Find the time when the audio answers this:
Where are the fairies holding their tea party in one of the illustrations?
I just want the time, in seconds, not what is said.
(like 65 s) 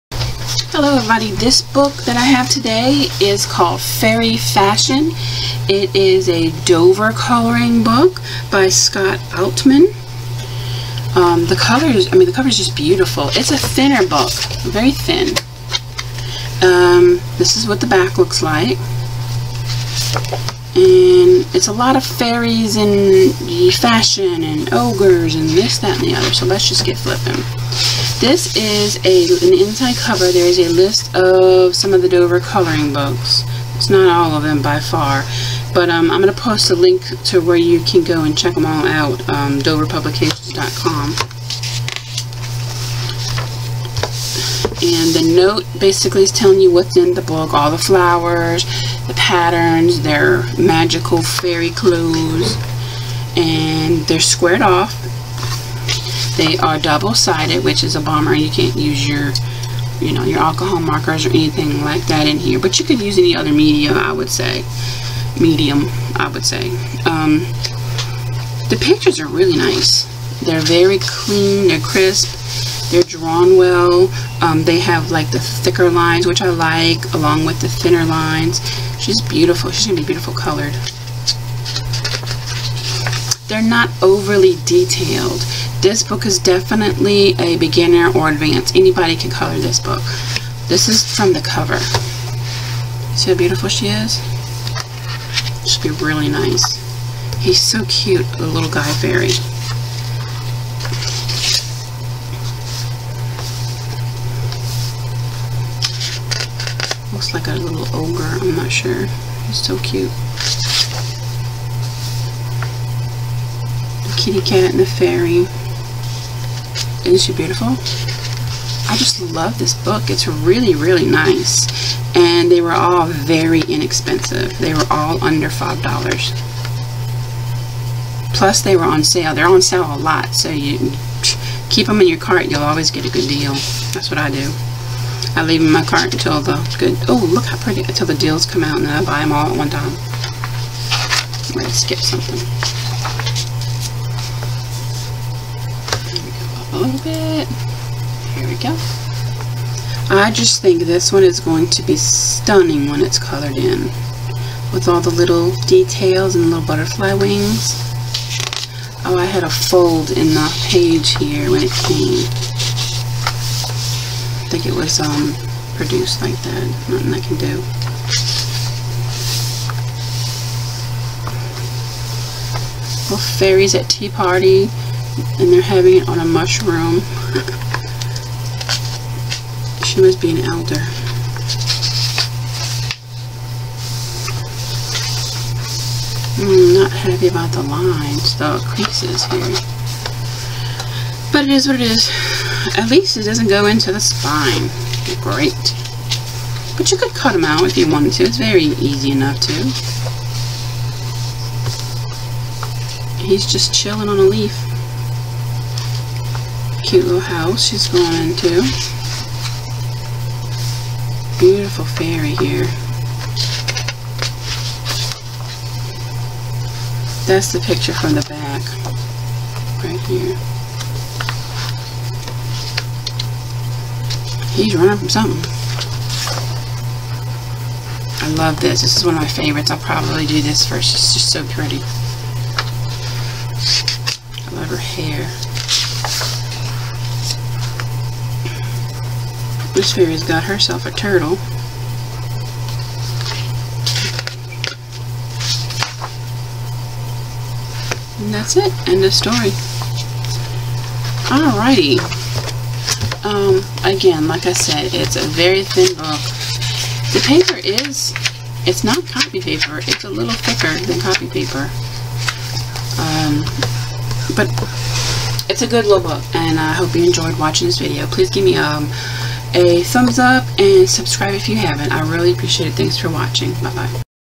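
176 s.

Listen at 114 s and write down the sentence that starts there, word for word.
The kitty cat and the fairy.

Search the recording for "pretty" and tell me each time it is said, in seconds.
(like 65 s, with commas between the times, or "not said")
137 s, 231 s.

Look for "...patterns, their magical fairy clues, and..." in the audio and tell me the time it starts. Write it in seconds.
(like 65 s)
49 s.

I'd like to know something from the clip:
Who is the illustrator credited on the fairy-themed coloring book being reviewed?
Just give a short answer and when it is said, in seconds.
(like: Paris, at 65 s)
Scott Altmann, at 8 s.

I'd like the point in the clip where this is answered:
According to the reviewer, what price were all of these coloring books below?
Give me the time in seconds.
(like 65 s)
125 s.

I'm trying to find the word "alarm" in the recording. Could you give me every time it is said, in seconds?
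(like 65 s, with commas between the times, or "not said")
not said.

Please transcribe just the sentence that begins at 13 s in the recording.
It's a thinner book, very thin.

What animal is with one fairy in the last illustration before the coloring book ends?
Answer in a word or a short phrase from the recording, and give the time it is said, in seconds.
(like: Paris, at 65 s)
A turtle, at 240 s.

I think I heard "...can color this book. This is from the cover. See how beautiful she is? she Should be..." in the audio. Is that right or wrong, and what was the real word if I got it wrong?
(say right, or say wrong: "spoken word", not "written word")
right.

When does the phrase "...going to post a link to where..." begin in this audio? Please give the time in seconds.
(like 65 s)
36 s.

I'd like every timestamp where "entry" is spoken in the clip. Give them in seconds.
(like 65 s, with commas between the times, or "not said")
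not said.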